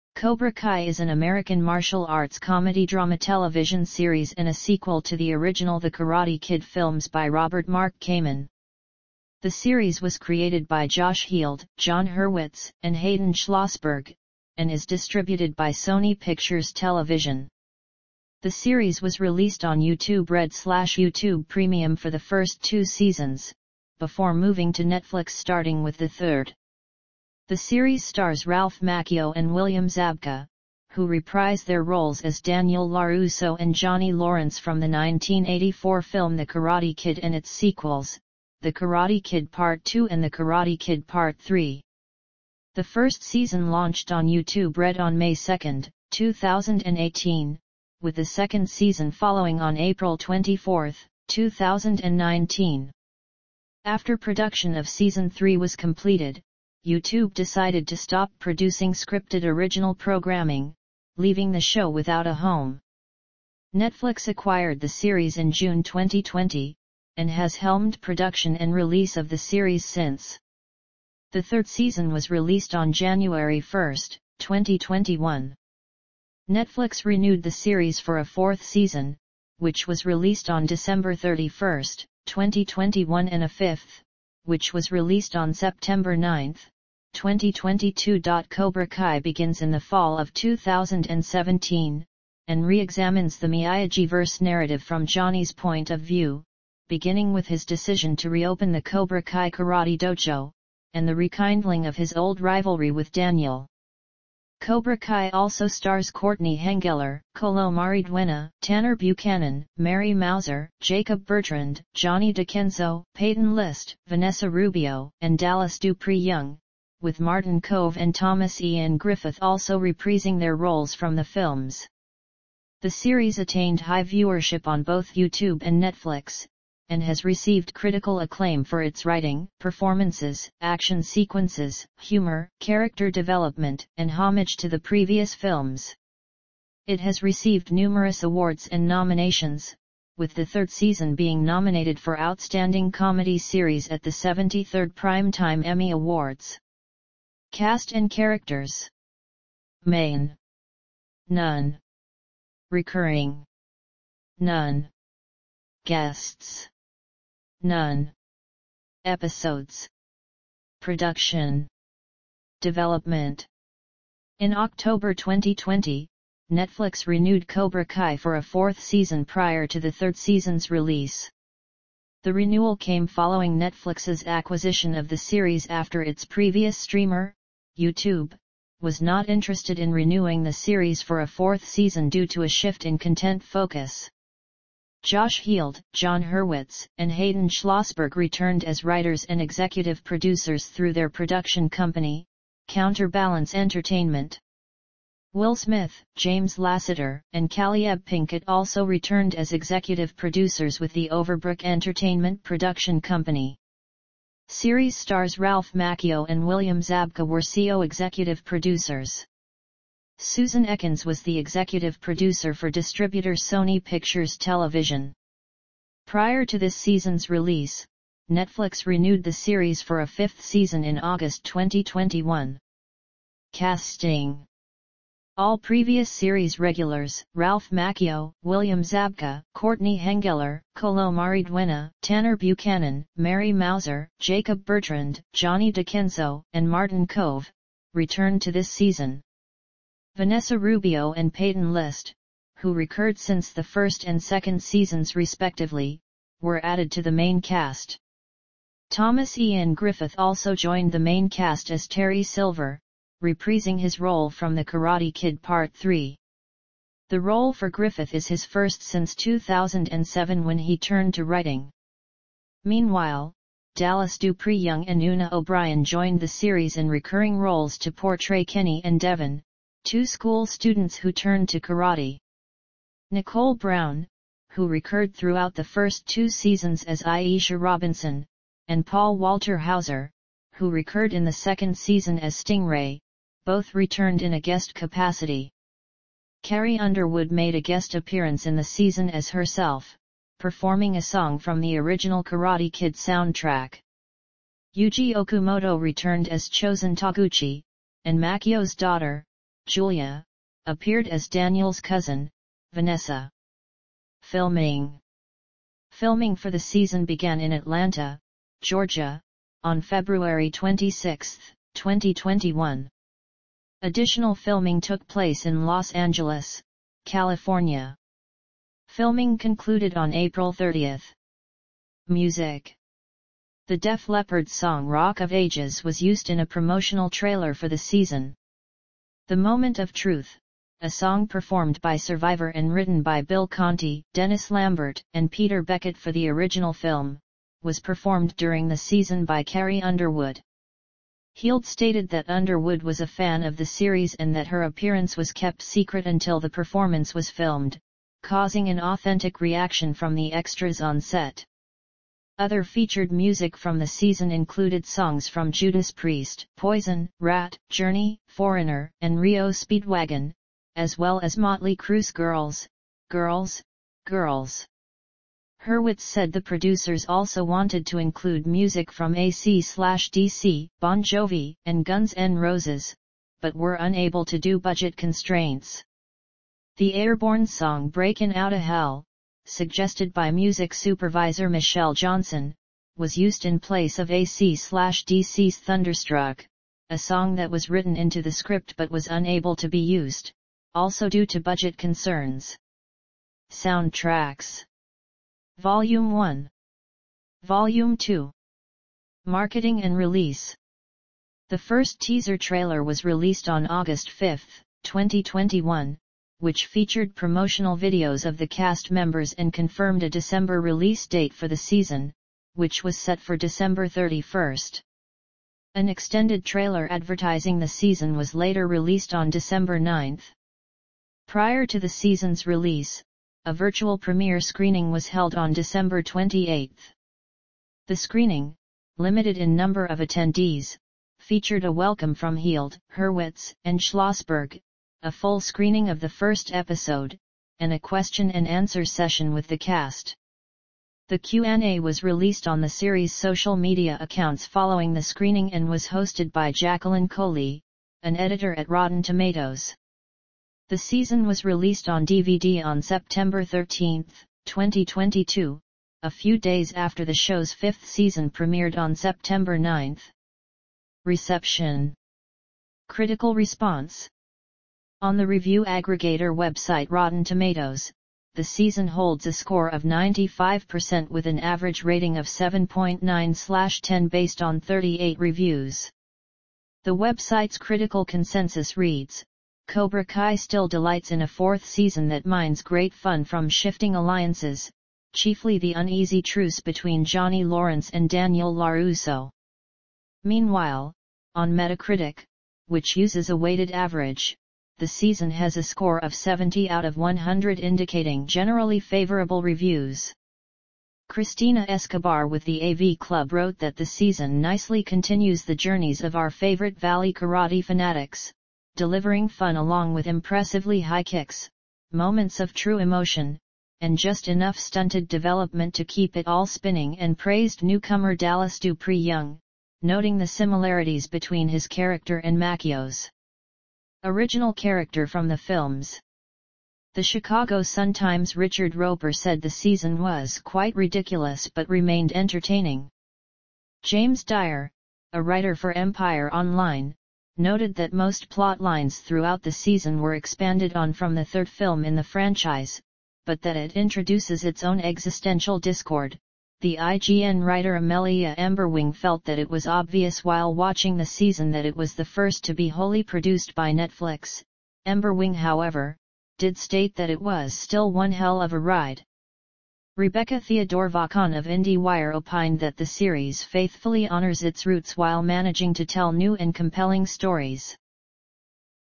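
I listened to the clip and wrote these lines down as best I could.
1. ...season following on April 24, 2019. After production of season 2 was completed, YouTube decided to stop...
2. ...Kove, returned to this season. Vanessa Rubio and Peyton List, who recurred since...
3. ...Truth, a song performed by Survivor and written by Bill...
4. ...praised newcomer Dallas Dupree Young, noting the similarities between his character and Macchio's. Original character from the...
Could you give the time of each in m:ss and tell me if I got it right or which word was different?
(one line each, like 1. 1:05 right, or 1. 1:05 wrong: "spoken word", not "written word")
1. 0:48 wrong: "3", not "2"
2. 3:57 right
3. 5:29 right
4. 8:37 right.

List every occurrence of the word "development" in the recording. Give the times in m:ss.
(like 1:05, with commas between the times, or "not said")
2:13, 2:42, 8:35.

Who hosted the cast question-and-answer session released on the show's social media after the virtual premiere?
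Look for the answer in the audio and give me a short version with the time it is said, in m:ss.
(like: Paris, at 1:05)
Jacqueline Coley, at 7:26.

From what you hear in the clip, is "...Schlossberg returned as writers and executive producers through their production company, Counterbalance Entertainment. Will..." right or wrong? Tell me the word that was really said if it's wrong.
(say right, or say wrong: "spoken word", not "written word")
right.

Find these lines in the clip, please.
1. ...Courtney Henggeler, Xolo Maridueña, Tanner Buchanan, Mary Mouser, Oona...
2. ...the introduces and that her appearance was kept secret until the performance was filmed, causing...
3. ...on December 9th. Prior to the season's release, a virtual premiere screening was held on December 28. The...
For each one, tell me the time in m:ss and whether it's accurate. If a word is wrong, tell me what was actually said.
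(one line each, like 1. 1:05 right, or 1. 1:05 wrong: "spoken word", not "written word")
1. 1:46 wrong: "Jacob", not "Oona"
2. 5:43 wrong: "series", not "introduces"
3. 6:59 right.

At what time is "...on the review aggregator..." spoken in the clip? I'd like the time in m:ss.
7:45.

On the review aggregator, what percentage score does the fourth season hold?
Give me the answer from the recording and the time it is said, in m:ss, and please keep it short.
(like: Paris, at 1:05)
95%, at 7:49.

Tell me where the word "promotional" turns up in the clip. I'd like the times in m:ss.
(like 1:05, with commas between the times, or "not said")
5:26, 6:47.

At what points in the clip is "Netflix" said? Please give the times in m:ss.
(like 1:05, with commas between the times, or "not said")
0:24, 1:03, 1:16, 2:05, 2:46, 2:53, 3:38, 9:13.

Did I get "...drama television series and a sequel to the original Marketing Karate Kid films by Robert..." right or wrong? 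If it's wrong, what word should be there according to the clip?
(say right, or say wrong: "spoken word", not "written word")
wrong: "The", not "Marketing".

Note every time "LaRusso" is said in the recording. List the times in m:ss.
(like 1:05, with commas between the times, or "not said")
0:32, 8:08.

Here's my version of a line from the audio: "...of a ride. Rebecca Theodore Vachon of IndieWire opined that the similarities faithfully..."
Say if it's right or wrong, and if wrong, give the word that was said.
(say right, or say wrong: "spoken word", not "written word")
wrong: "series", not "similarities".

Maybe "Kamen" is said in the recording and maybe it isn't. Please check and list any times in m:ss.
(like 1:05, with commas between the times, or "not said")
0:07.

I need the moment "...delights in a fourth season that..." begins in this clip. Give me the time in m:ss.
8:00.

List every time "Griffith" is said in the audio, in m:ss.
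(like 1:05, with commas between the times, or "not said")
1:58, 4:09, 4:17.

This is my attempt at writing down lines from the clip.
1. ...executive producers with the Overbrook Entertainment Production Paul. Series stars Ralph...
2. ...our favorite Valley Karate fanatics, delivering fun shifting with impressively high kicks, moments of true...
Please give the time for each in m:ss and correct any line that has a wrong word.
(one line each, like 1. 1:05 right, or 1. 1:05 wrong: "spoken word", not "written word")
1. 3:19 wrong: "Company", not "Paul"
2. 8:26 wrong: "along", not "shifting".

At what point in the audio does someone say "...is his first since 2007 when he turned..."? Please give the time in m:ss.
4:18.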